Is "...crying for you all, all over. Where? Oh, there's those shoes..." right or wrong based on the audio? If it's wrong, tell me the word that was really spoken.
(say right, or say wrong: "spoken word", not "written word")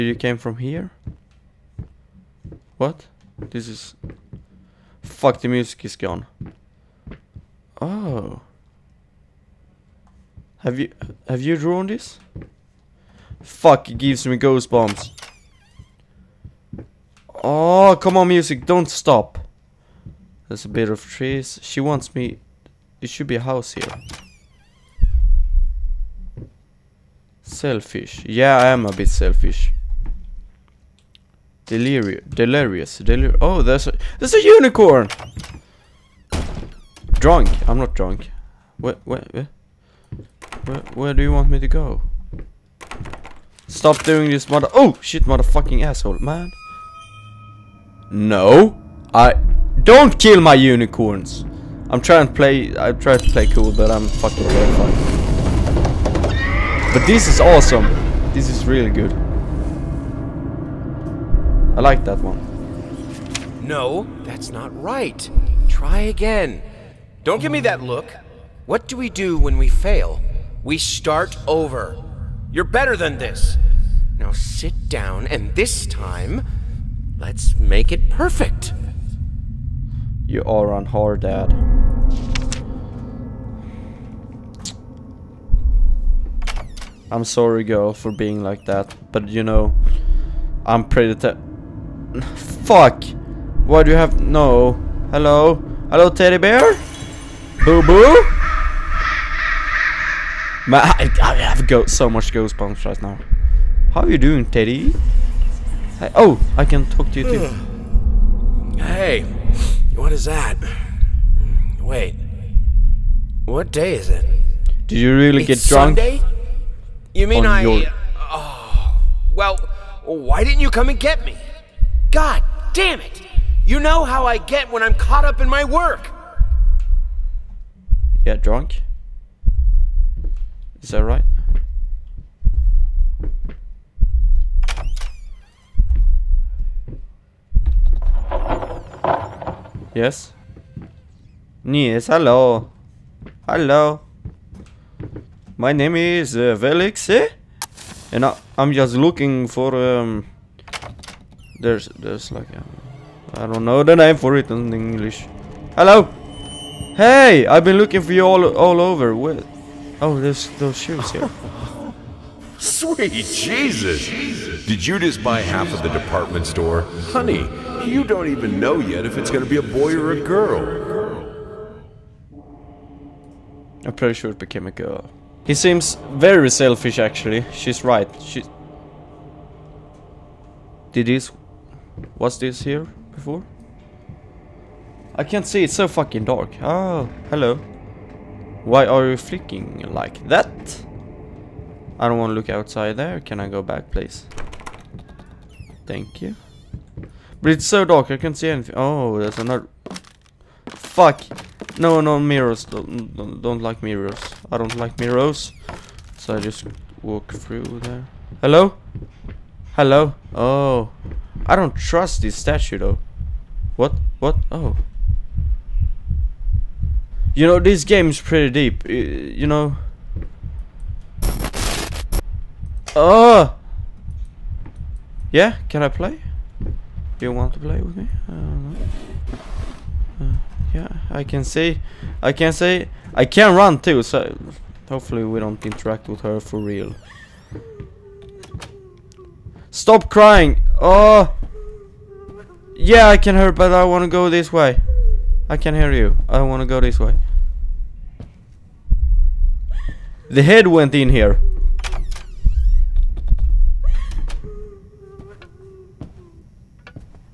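wrong: "looking", not "crying".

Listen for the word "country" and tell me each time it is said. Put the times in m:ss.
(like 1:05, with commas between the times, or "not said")
not said.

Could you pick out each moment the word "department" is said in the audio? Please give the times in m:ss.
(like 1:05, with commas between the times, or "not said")
2:45.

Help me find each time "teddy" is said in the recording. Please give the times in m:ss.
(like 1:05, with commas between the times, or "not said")
1:36, 1:44.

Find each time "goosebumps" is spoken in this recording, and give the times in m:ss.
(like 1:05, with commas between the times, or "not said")
0:14, 1:42.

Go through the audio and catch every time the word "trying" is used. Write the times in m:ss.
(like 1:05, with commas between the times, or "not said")
0:51.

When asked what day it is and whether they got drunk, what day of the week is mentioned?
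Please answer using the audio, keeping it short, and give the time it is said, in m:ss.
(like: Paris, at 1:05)
Sunday, at 1:55.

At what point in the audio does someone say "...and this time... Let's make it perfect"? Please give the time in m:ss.
1:15.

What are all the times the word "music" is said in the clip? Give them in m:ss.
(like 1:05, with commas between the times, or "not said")
0:05, 0:18.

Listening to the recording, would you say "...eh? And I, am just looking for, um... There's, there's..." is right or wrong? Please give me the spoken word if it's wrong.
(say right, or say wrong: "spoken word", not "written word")
right.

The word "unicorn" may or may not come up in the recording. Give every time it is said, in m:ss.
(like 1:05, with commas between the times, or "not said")
0:34, 0:50.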